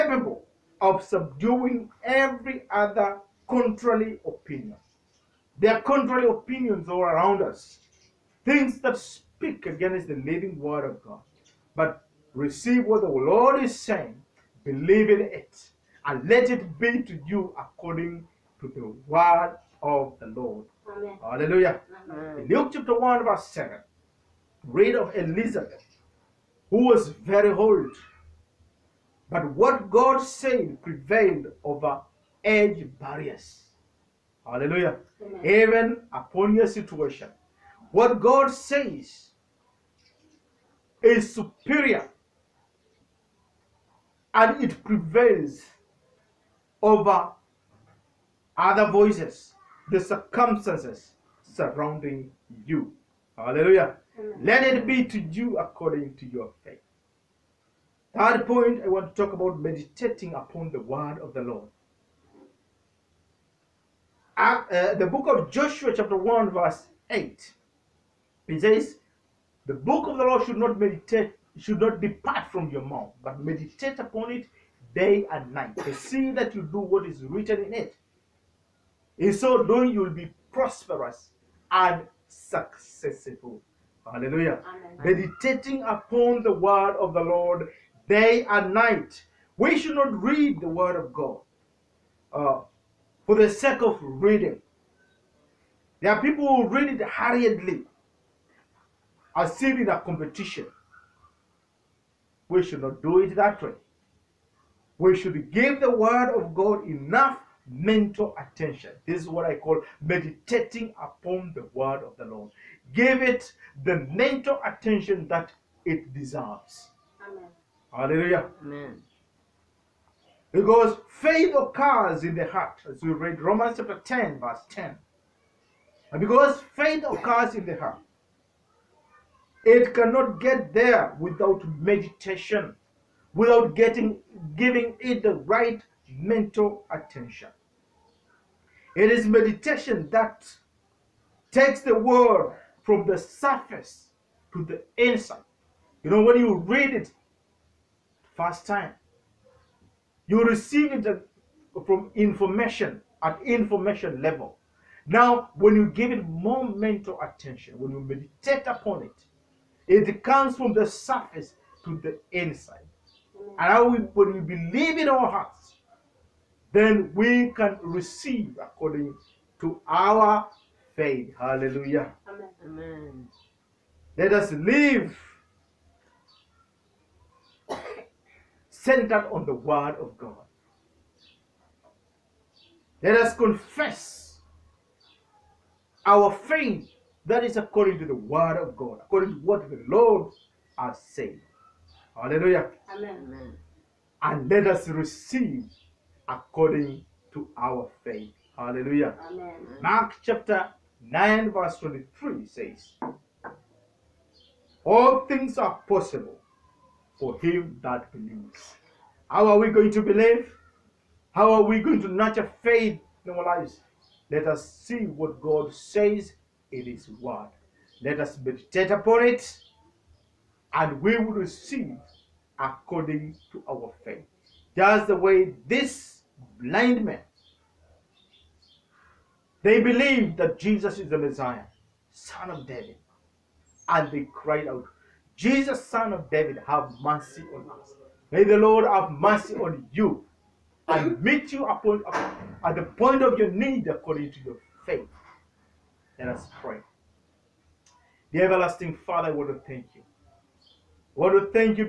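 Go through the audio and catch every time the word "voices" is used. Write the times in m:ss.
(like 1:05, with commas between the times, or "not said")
0:48.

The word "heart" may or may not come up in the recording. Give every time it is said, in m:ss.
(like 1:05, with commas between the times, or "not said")
2:02, 2:07, 2:45.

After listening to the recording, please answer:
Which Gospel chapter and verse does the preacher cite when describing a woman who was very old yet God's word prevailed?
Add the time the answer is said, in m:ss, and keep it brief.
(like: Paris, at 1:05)
Luke 1:7, at 0:22.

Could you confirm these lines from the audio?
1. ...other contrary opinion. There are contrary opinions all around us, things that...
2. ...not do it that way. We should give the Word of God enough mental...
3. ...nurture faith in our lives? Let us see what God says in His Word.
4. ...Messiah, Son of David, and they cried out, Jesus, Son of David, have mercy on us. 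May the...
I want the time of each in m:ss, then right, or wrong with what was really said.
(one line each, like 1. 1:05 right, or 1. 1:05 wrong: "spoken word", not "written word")
1. 0:02 right
2. 1:42 right
3. 3:32 right
4. 3:51 right.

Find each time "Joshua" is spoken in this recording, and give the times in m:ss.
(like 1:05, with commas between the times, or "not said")
1:05.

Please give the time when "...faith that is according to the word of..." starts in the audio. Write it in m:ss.
3:06.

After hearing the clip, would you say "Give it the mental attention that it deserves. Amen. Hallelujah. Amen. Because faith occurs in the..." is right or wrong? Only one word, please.
right.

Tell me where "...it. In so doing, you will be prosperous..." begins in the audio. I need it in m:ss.
1:17.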